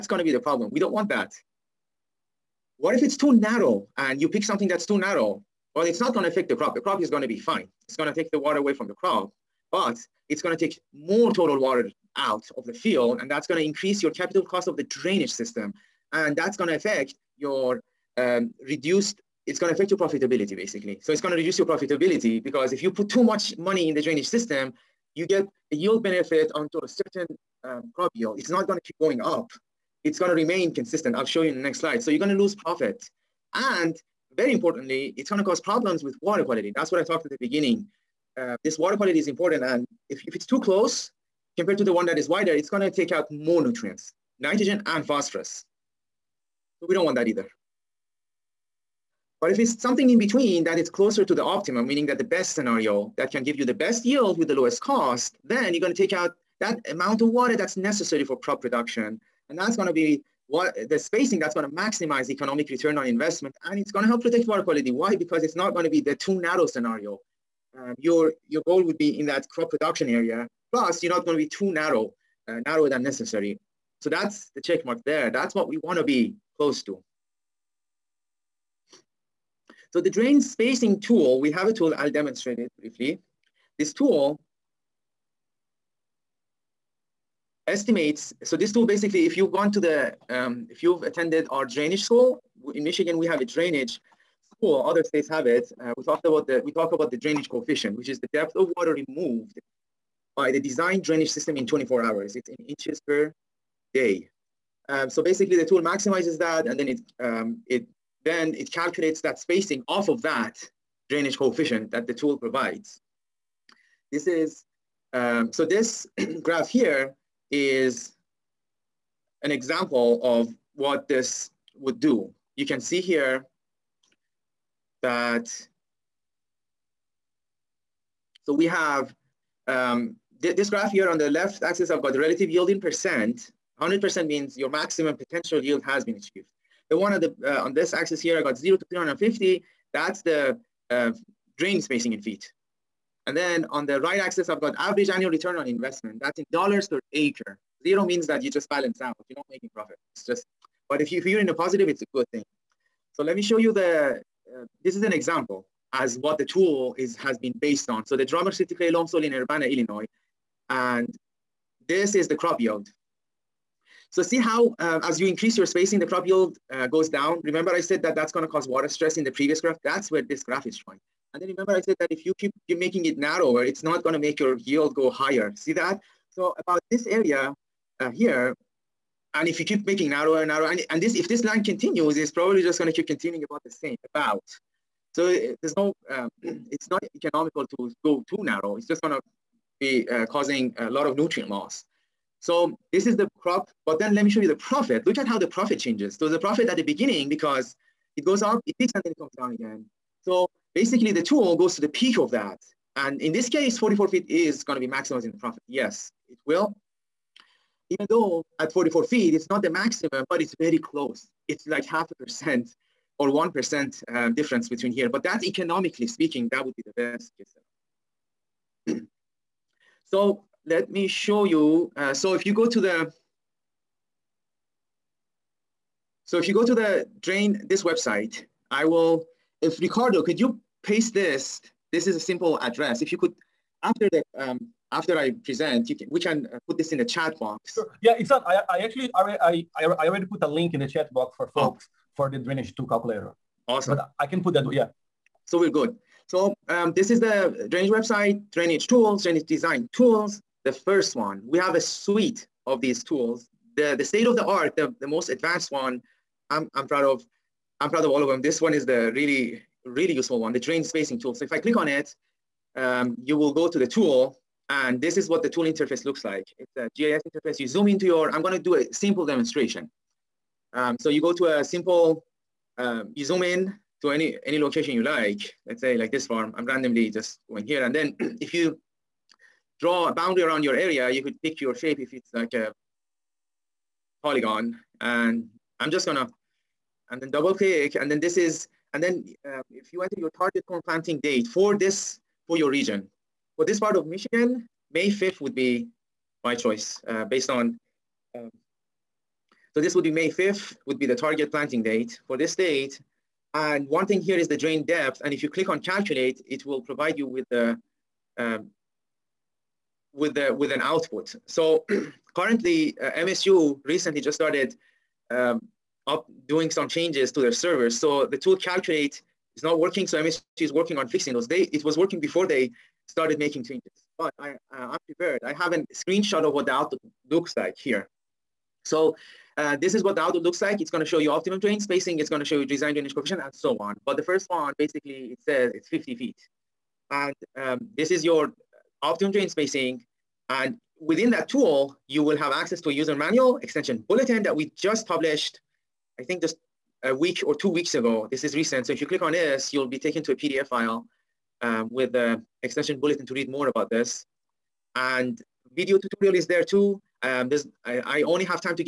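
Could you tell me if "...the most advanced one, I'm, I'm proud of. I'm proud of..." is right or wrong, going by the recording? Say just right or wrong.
right.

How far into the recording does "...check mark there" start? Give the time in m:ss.
1:14.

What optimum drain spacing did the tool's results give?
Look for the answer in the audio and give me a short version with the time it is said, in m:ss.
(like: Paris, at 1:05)
50 feet, at 5:35.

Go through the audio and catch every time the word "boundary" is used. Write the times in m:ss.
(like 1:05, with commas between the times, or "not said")
4:40.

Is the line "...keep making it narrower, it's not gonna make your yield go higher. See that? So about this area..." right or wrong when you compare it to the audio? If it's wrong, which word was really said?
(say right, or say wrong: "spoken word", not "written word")
right.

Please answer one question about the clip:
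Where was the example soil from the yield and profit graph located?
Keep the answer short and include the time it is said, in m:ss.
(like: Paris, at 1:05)
Urbana, Illinois, at 2:39.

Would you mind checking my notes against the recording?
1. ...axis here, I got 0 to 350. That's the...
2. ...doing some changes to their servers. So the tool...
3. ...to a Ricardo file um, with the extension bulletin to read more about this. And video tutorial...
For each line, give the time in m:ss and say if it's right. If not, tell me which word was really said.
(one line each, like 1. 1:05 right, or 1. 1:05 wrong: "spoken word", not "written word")
1. 2:17 right
2. 5:16 right
3. 5:50 wrong: "PDF", not "Ricardo".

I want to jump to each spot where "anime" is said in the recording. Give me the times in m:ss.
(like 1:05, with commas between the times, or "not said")
not said.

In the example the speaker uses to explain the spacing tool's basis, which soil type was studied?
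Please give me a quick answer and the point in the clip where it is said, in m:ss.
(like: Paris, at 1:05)
Drummer silty clay, at 2:38.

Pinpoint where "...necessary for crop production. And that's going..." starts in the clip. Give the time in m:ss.
0:57.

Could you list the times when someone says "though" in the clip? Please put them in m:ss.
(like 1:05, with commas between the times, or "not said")
3:28.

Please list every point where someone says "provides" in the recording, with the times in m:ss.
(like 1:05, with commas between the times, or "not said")
1:52, 5:06.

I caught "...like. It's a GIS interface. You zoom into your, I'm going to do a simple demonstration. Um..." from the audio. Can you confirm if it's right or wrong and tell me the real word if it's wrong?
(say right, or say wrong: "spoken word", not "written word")
right.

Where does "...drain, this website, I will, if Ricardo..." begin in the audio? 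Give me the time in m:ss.
3:47.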